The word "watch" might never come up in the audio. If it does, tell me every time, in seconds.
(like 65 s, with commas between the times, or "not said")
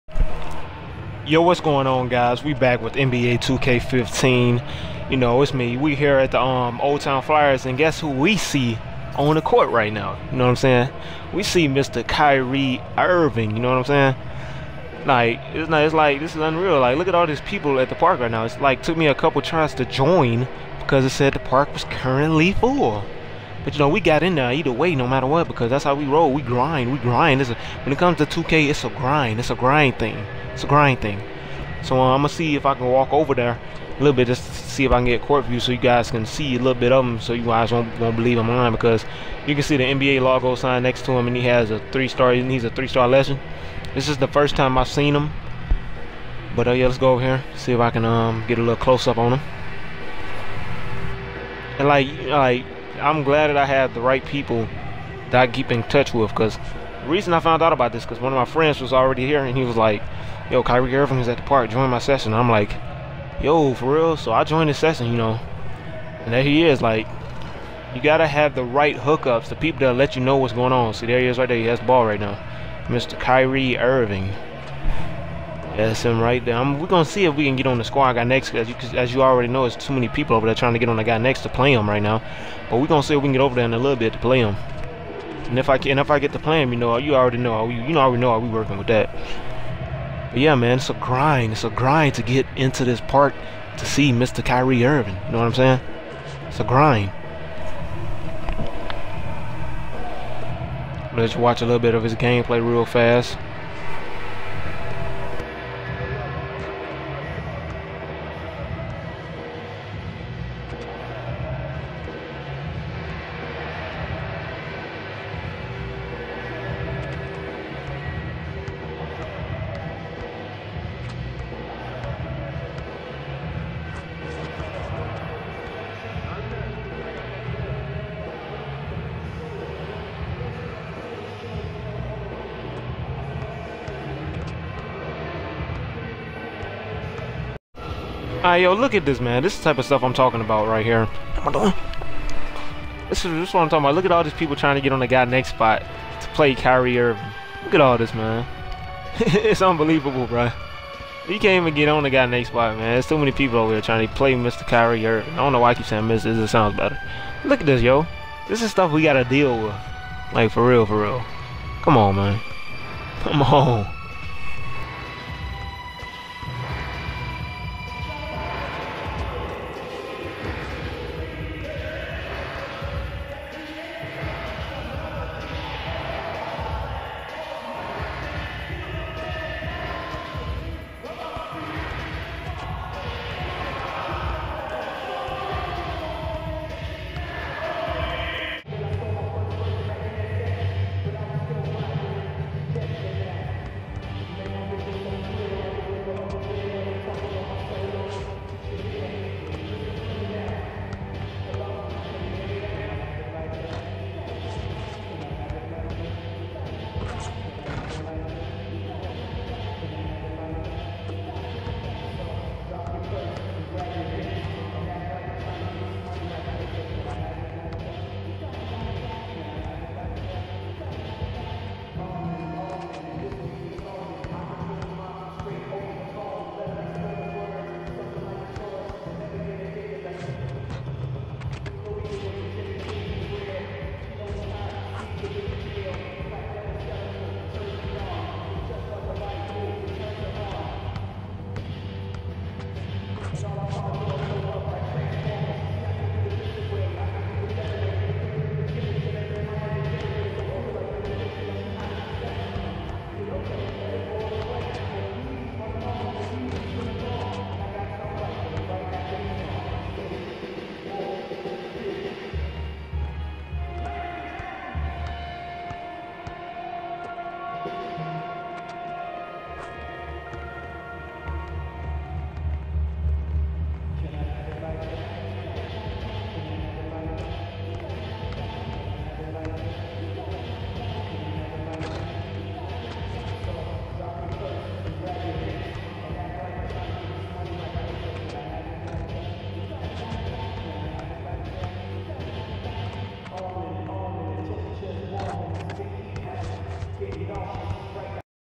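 101 s.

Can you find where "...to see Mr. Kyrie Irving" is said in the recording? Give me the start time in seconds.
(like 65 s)
93 s.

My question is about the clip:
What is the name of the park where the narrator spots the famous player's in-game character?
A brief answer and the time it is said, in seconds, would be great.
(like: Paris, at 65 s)
Old Town Flyers, at 6 s.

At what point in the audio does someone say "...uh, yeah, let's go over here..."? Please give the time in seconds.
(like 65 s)
46 s.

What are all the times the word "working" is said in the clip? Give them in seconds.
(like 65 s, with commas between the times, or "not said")
88 s.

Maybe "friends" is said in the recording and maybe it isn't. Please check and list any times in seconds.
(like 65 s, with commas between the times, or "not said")
58 s.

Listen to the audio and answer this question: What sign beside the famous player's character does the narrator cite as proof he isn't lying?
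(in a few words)
NBA logo.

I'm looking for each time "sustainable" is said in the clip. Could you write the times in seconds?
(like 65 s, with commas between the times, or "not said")
not said.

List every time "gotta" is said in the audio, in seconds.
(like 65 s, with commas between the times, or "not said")
68 s, 159 s.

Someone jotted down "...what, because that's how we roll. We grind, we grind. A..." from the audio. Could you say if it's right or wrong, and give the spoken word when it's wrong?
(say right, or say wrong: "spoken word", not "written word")
right.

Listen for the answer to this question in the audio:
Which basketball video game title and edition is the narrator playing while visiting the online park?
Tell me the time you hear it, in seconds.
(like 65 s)
2 s.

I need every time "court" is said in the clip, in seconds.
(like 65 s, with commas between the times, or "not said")
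9 s, 35 s.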